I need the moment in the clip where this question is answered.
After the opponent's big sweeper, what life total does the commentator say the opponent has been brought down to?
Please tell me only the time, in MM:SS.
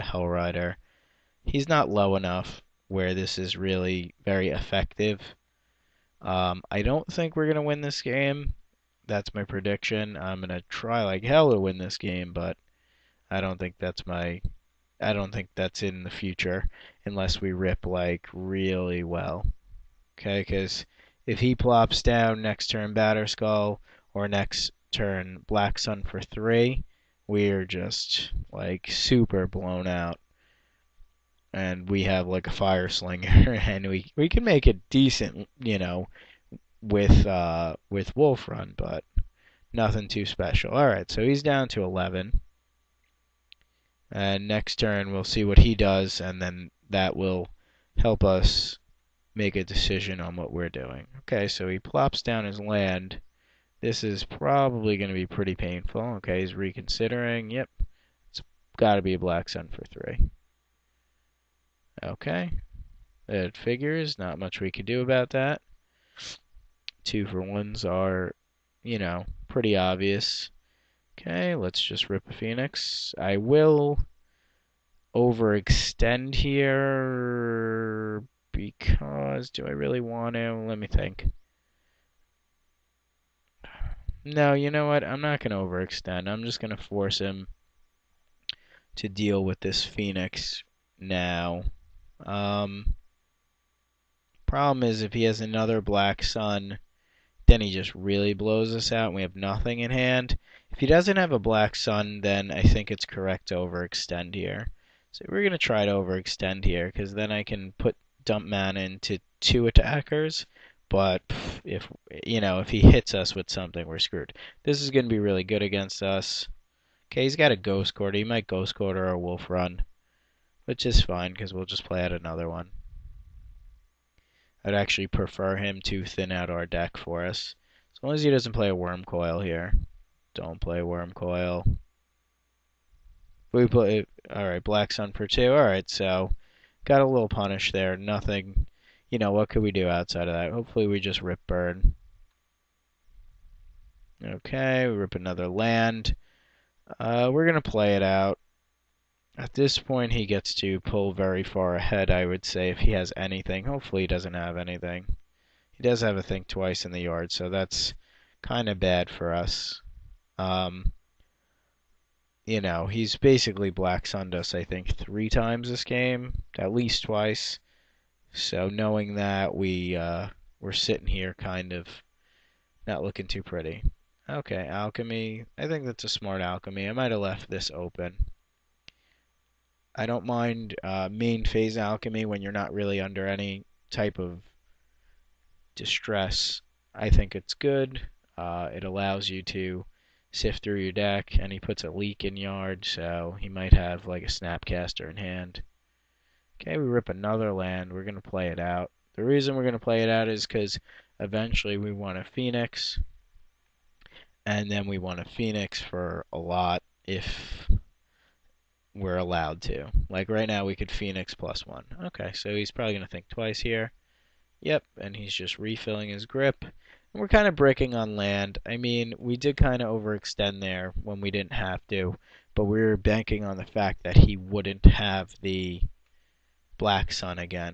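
00:41.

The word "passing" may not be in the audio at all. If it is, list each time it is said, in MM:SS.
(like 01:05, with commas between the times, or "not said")
not said.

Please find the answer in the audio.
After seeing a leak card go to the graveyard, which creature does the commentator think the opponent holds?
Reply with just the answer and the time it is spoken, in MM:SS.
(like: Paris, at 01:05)
Snapcaster, at 03:14.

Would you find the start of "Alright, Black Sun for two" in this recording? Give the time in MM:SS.
02:14.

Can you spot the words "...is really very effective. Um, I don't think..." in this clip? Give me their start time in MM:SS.
00:03.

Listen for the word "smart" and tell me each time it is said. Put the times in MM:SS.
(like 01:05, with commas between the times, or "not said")
02:56.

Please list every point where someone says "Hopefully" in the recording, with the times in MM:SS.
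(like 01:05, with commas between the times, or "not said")
02:20, 02:33.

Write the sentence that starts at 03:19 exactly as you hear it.
The reason we're going to play it out is because eventually we want a Phoenix.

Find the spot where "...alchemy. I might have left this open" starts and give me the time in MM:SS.
02:56.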